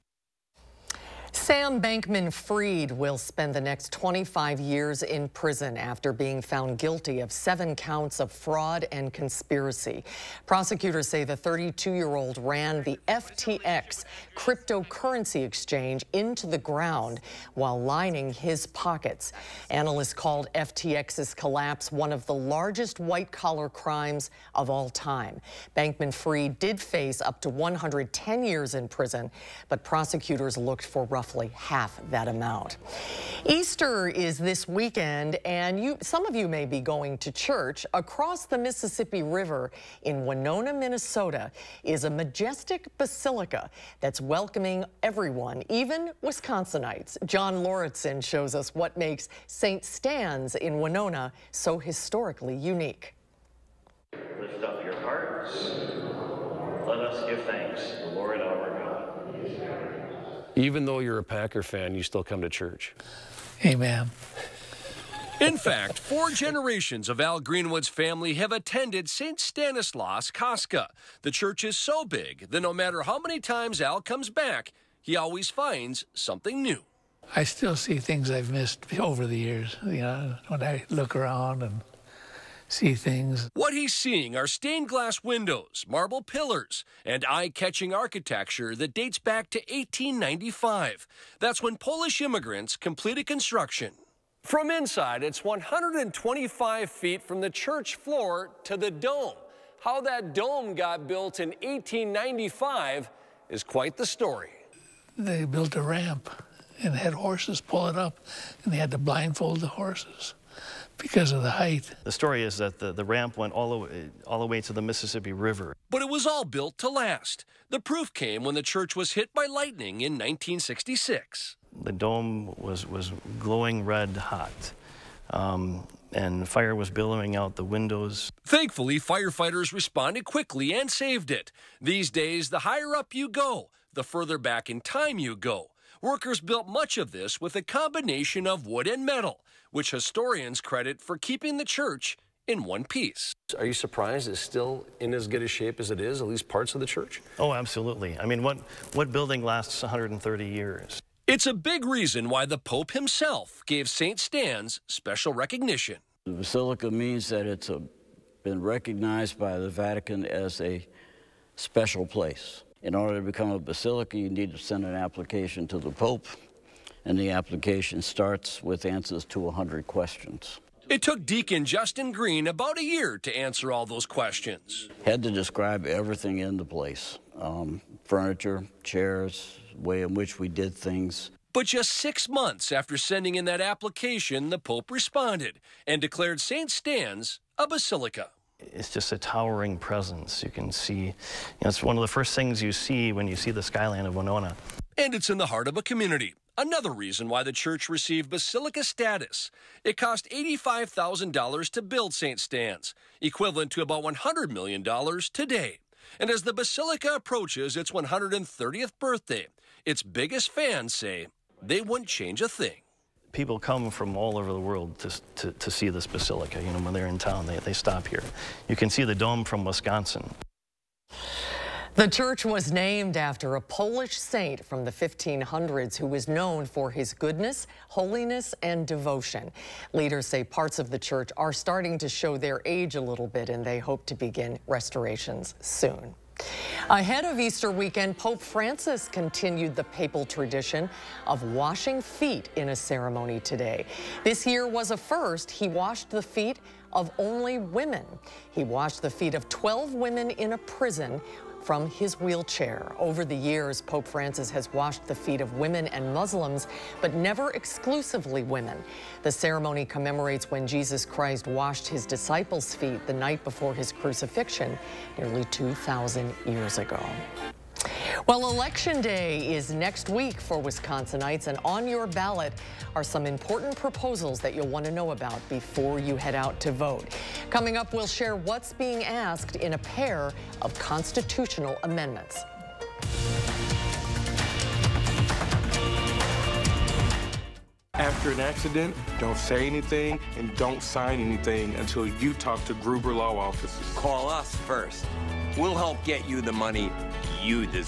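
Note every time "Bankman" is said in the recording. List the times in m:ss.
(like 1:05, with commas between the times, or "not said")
0:01, 0:25.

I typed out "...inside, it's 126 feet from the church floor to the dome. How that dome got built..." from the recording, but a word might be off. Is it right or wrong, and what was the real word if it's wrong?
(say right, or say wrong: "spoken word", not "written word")
wrong: "125", not "126".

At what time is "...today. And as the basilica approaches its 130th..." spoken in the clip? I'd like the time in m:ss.
3:25.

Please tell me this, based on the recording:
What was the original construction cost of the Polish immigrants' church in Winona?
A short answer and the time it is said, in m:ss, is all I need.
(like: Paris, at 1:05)
$85,000, at 3:20.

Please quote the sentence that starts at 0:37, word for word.
Across the Mississippi River in Winona, Minnesota, is a majestic basilica that's welcoming everyone, even Wisconsinites.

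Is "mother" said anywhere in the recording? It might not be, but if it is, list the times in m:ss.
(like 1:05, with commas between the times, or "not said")
not said.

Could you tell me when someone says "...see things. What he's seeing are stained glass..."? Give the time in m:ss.
1:22.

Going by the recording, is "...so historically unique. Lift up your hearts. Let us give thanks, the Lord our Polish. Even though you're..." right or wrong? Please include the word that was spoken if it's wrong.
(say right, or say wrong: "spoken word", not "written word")
wrong: "God", not "Polish".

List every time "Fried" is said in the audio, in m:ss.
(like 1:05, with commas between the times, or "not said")
0:02, 0:26.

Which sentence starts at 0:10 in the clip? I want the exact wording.
Prosecutors say the 32 year old ran the FTX cryptocurrency exchange into the ground while lining his pockets.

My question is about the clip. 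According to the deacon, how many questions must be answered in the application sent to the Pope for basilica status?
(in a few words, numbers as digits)
100.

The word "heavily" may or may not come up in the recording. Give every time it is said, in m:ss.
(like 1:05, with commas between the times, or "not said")
not said.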